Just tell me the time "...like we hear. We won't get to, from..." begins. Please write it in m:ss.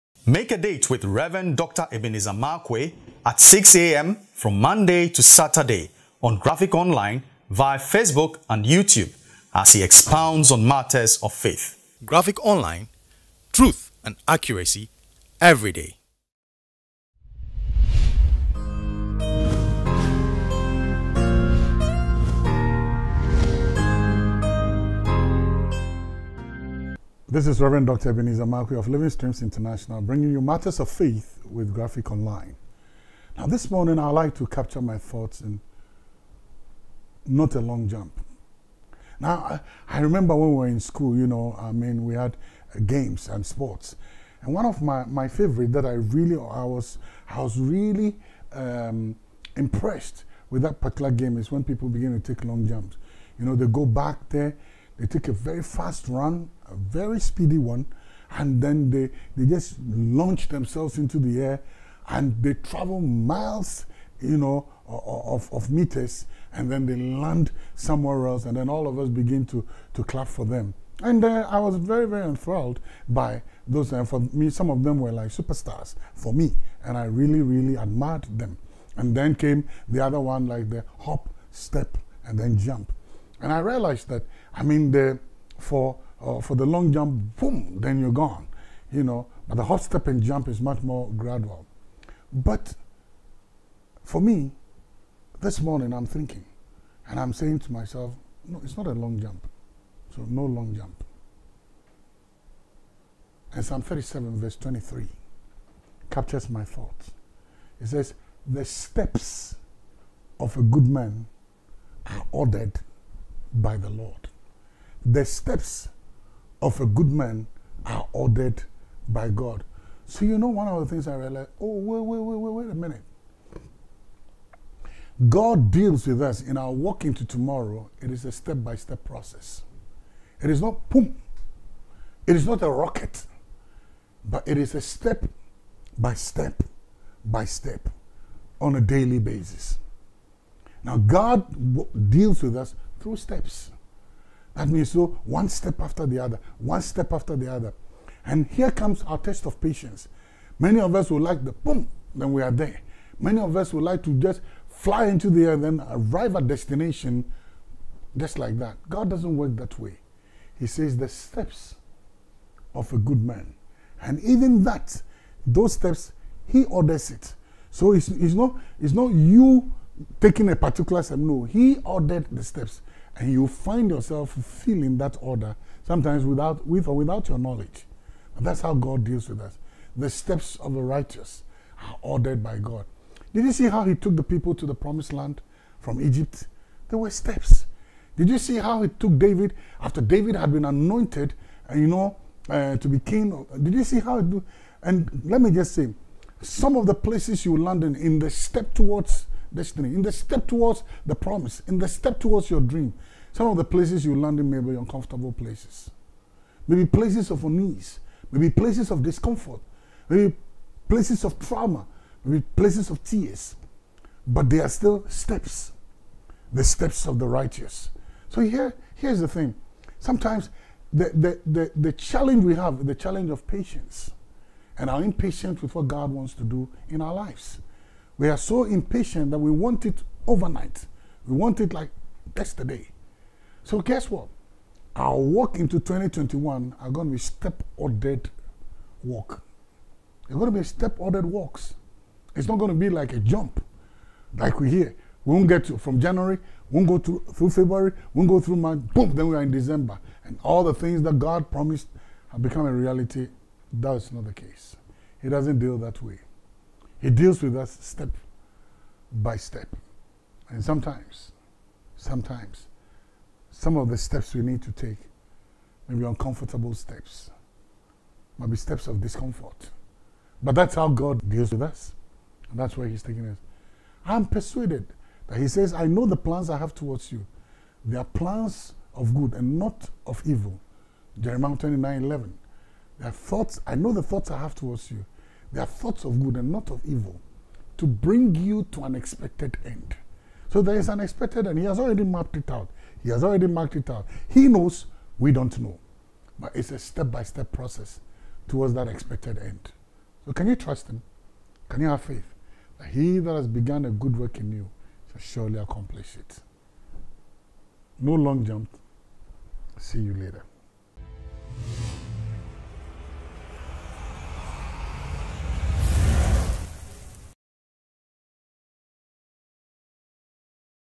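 4:04.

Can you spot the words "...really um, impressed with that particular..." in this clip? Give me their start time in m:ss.
0:47.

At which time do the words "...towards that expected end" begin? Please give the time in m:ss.
4:58.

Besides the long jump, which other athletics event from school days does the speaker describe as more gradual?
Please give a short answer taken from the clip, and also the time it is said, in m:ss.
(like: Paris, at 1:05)
Hop, step, and jump, at 1:20.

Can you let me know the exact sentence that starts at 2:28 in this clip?
And here comes our test of patience.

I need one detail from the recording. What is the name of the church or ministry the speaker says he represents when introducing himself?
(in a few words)
Living Streams International.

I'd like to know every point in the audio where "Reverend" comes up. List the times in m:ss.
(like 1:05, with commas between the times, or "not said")
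0:01, 0:27.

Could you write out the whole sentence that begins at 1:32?
But for me, this morning I'm thinking, and I'm saying to myself, no, it's not a long jump.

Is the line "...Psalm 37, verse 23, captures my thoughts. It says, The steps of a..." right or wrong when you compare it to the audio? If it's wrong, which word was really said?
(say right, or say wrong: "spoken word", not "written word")
right.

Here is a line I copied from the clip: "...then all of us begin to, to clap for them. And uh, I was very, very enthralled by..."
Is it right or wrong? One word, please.
right.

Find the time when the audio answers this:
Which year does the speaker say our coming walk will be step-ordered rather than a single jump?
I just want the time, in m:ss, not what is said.
3:55.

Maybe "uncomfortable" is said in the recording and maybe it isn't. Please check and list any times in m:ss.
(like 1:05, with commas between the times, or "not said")
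3:24, 4:26.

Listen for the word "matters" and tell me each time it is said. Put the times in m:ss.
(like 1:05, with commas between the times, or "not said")
0:10, 0:30.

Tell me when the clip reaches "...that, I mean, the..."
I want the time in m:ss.
1:24.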